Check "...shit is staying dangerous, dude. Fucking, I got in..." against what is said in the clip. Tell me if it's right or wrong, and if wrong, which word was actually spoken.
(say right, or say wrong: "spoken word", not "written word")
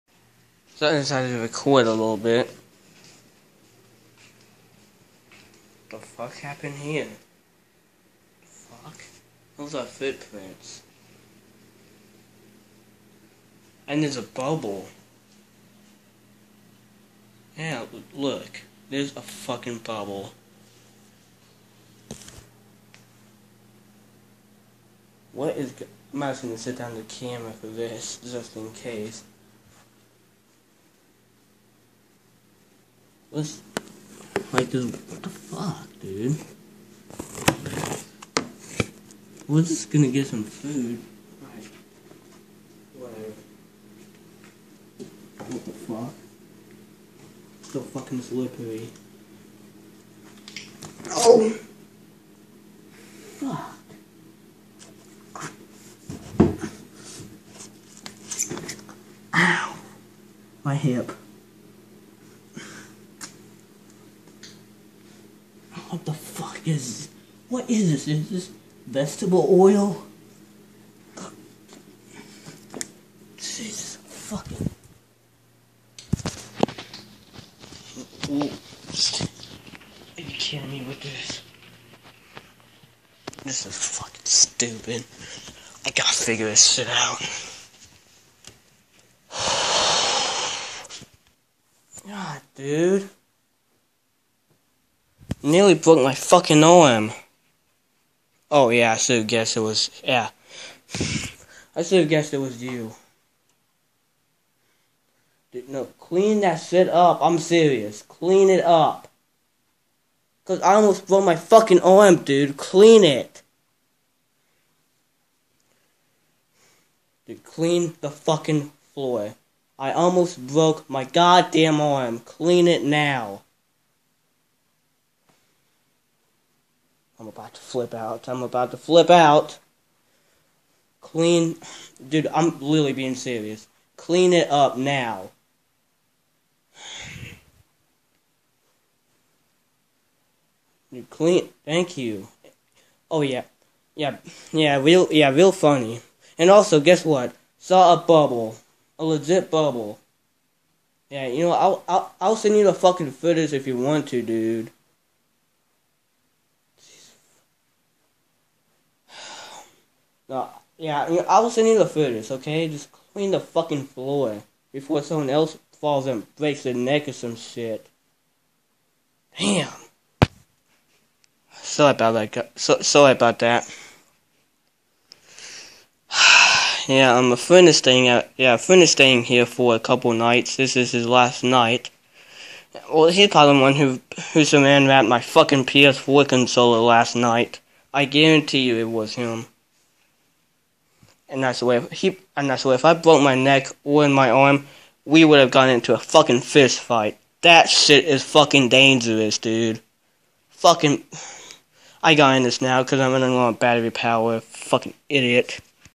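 wrong: "fucking", not "staying".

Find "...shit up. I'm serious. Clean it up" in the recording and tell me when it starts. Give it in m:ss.
1:46.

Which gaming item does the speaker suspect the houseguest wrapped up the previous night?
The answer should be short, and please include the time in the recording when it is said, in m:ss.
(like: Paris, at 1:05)
PS4 controller, at 3:05.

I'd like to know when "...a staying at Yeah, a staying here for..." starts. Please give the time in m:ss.
2:57.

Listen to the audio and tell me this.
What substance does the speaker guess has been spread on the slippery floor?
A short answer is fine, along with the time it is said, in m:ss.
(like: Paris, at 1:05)
Vegetable oil, at 1:08.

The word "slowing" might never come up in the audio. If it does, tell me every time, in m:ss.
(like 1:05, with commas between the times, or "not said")
not said.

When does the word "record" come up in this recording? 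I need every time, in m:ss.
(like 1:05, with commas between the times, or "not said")
0:01.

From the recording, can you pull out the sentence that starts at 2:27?
Saw a bubble, a legit bubble.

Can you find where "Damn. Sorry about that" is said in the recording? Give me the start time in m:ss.
2:49.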